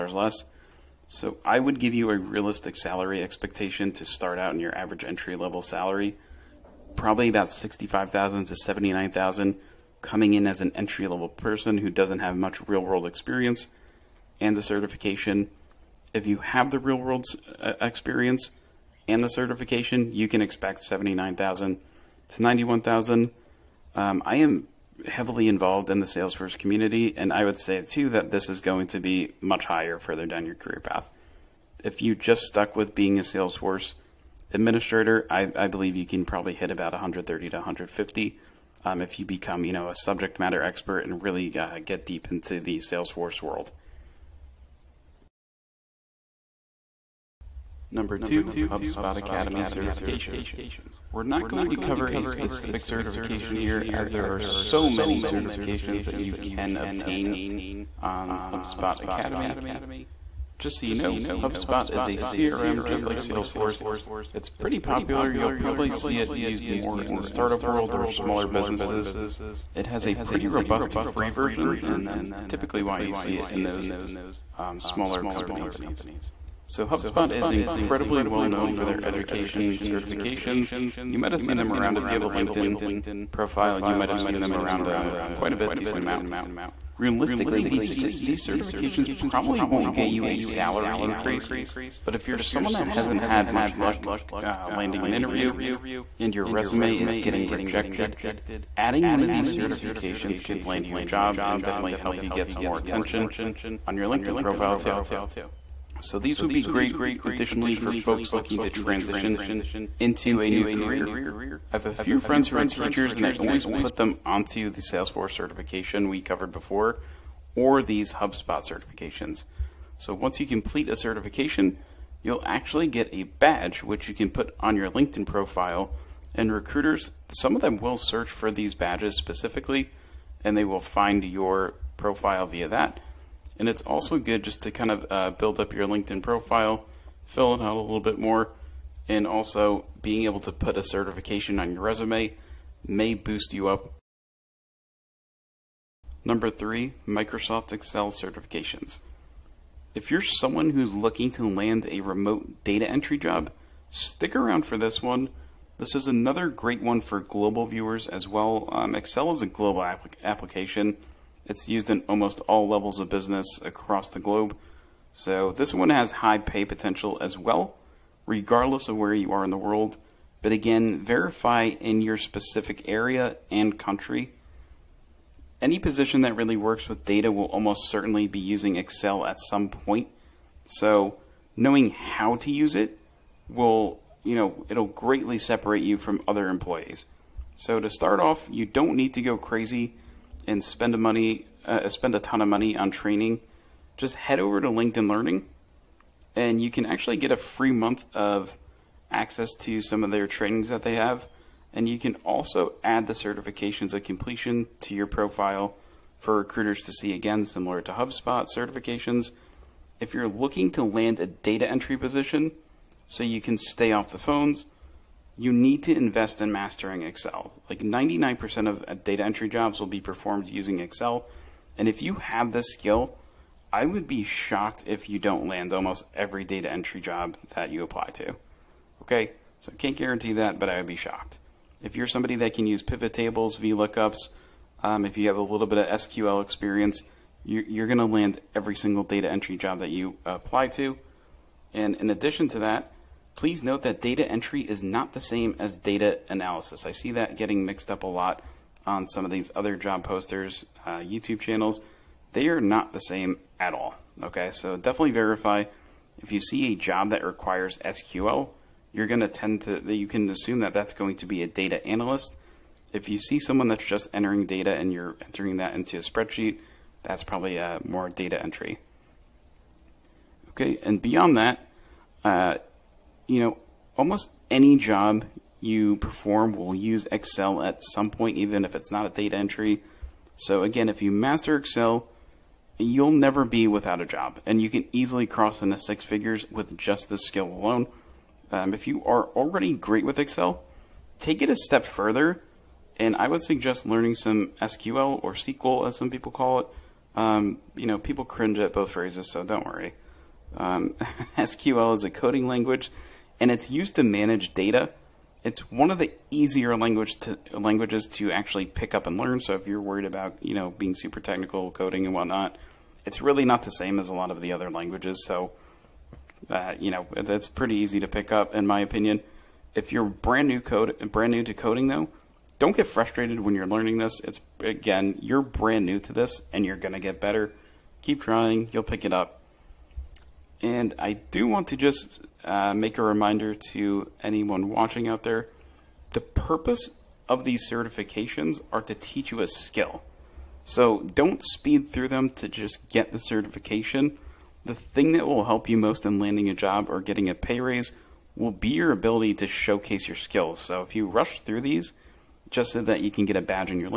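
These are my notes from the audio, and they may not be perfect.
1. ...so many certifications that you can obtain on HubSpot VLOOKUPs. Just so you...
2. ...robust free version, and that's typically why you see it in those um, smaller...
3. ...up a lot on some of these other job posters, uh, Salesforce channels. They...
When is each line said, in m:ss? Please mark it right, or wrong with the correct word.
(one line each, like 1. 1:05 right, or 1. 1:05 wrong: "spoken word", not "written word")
1. 0:54 wrong: "Academy", not "VLOOKUPs"
2. 1:10 right
3. 4:07 wrong: "YouTube", not "Salesforce".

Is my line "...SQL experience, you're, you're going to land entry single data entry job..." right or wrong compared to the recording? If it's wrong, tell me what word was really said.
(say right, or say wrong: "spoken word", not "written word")
wrong: "every", not "entry".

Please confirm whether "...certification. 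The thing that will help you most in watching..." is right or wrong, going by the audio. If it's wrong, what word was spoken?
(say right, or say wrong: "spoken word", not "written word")
wrong: "landing", not "watching".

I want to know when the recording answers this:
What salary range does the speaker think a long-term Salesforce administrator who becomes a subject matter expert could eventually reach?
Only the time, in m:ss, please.
0:36.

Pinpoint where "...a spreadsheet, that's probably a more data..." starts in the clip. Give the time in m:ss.
4:25.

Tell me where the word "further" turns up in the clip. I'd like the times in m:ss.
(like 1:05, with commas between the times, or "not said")
0:29, 4:51.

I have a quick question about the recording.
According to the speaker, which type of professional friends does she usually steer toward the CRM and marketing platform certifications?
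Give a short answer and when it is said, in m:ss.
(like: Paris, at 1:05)
teachers, at 1:52.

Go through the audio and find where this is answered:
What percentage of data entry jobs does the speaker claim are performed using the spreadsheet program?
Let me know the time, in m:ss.
3:37.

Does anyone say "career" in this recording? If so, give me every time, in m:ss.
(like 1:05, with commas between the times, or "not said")
0:30, 1:50.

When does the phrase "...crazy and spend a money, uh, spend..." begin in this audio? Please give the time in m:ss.
3:09.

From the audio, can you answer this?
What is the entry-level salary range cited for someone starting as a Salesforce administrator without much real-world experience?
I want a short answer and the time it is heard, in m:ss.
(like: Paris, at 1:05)
65,000 to 79,000, at 0:07.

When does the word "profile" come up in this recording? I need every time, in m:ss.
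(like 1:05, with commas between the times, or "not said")
1:23, 1:44, 2:05, 2:11, 2:16, 3:25.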